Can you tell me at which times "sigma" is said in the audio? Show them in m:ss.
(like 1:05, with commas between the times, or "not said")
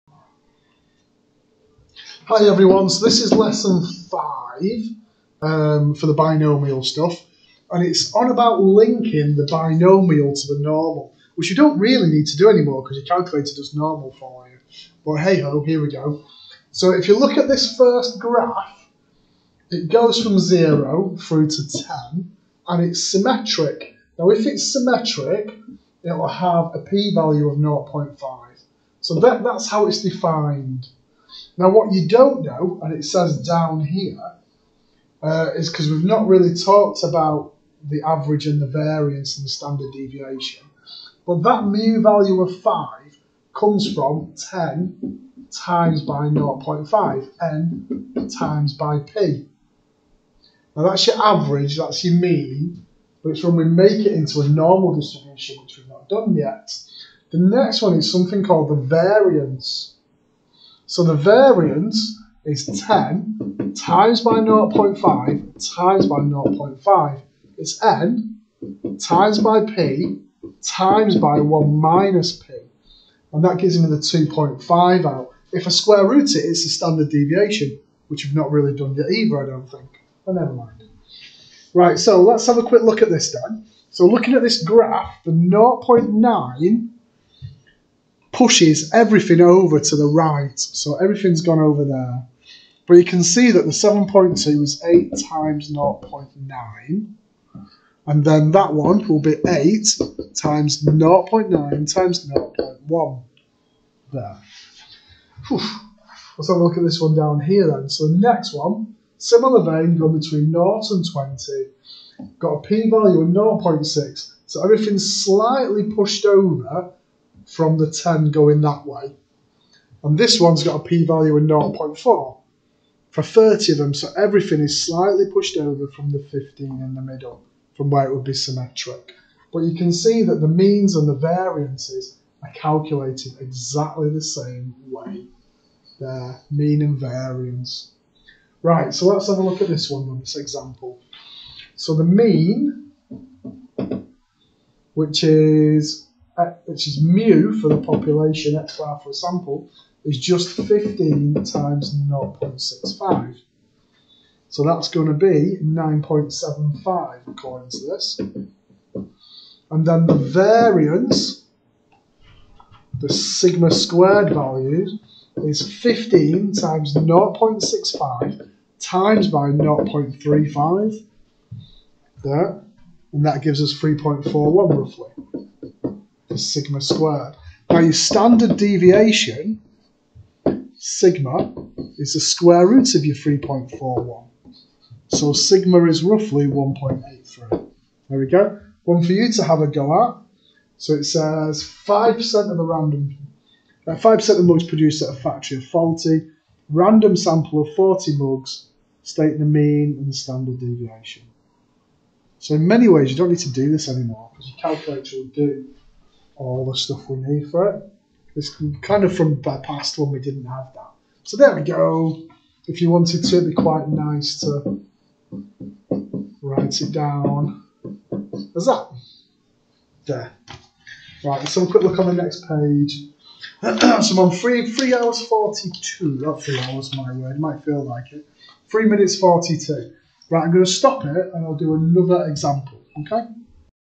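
2:43, 2:56, 3:00, 3:05.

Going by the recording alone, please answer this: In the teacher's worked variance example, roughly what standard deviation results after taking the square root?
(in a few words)
1.83.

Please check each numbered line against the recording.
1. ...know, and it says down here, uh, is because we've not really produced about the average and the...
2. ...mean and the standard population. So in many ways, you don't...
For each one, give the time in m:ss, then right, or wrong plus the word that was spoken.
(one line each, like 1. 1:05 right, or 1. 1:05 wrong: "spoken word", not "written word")
1. 0:32 wrong: "talked", not "produced"
2. 3:19 wrong: "deviation", not "population".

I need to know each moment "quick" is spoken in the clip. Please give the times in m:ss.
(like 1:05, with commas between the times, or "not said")
1:22, 3:41.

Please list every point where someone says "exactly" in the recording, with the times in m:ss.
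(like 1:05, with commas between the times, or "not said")
2:13.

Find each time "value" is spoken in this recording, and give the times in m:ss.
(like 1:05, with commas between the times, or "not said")
0:26, 0:42, 1:52, 2:01, 2:44.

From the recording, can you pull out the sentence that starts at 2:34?
So that's going to be 9.75 according to this.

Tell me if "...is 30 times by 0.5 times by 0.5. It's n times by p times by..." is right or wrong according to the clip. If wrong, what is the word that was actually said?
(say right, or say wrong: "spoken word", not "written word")
wrong: "10", not "30".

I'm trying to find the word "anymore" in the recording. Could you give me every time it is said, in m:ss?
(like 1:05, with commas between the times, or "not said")
0:12, 3:23.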